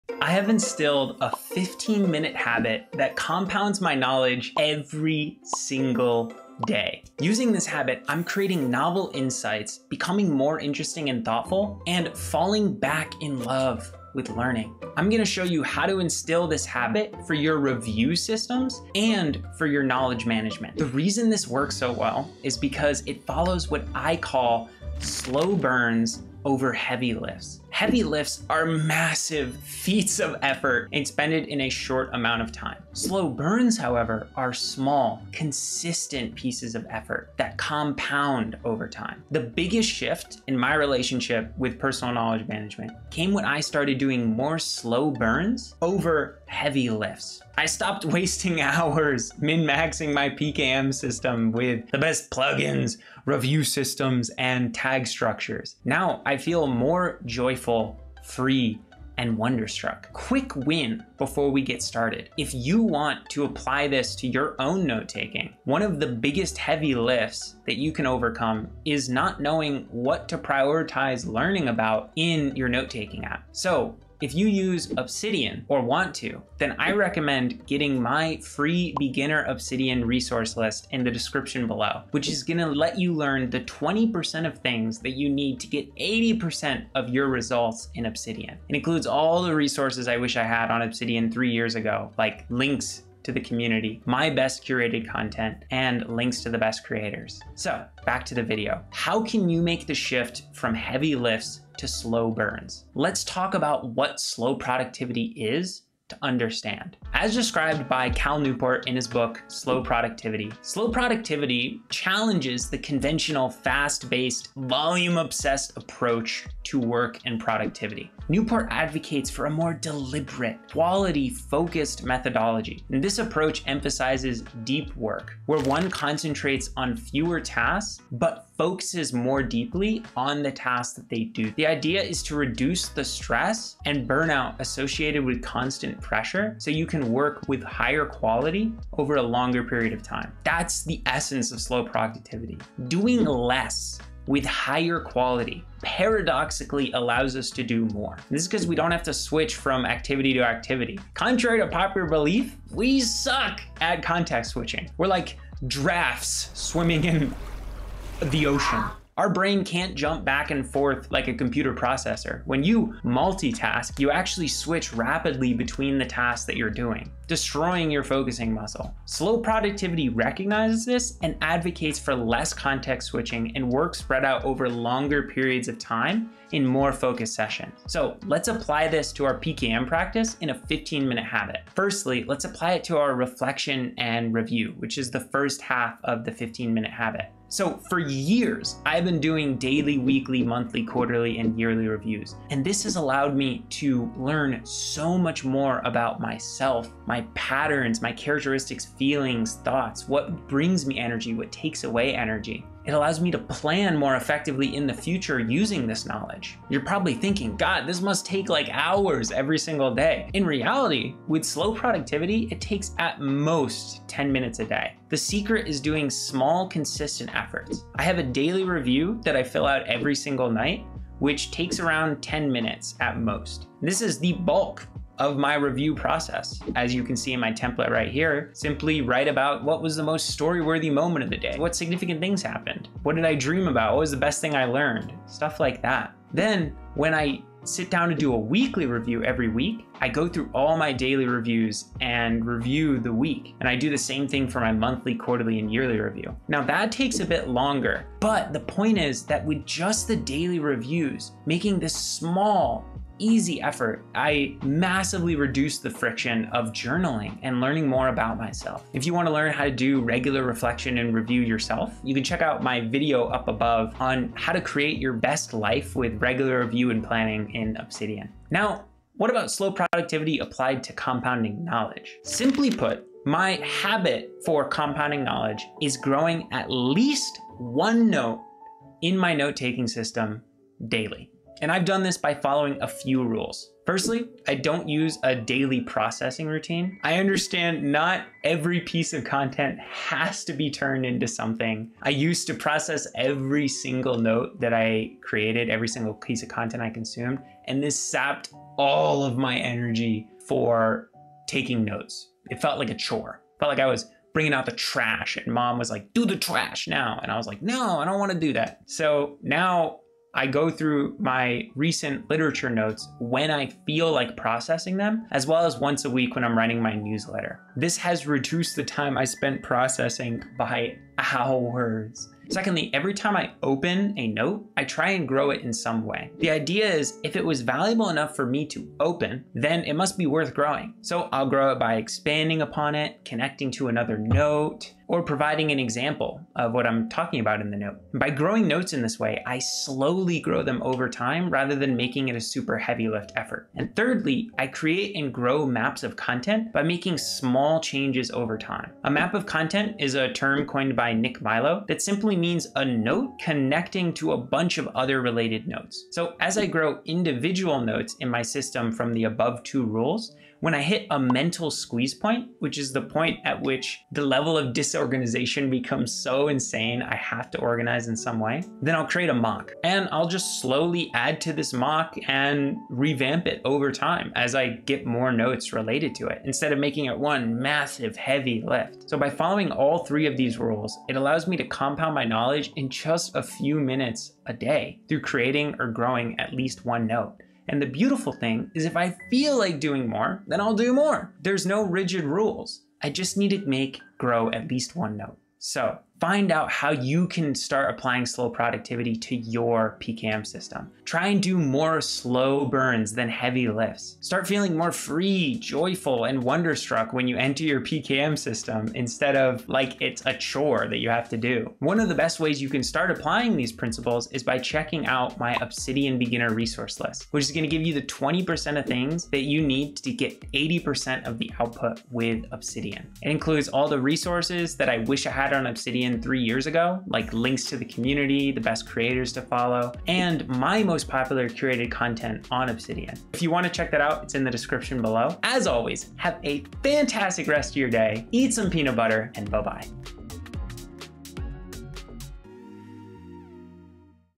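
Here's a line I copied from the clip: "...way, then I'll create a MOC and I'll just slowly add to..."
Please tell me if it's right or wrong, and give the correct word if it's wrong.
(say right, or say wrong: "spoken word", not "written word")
right.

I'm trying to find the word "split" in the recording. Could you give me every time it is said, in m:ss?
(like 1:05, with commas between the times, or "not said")
not said.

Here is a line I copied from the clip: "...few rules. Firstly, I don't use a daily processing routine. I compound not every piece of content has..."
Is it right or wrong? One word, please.
wrong.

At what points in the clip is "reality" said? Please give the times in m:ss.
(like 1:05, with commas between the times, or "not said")
3:30.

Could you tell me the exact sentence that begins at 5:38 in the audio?
By growing notes in this way, I slowly grow them over time rather than making it a super heavy lift effort.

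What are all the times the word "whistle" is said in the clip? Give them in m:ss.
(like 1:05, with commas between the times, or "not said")
not said.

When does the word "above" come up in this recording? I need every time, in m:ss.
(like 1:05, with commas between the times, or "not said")
4:23, 5:59.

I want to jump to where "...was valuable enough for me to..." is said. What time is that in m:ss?
5:27.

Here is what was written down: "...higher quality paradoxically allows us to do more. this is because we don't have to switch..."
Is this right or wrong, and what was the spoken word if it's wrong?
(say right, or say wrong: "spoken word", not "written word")
right.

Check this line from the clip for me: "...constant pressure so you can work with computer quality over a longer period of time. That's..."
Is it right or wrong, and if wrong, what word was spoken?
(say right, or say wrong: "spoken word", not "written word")
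wrong: "higher", not "computer".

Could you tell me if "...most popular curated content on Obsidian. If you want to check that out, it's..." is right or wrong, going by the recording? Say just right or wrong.
right.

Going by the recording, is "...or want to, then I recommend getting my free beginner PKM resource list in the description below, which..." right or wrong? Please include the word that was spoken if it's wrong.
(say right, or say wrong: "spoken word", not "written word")
wrong: "Obsidian", not "PKM".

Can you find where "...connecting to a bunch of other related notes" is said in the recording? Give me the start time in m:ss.
5:53.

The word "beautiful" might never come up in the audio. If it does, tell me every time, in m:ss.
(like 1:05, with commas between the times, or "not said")
6:27.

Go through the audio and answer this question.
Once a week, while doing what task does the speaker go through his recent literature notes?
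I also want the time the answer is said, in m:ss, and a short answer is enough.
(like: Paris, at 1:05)
writing my newsletter, at 5:16.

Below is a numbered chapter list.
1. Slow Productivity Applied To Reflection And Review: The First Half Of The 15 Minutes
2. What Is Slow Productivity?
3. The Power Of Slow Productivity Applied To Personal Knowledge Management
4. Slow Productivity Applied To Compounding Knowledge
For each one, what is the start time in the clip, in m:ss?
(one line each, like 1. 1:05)
1. 3:33
2. 1:44
3. 6:36
4. 4:29.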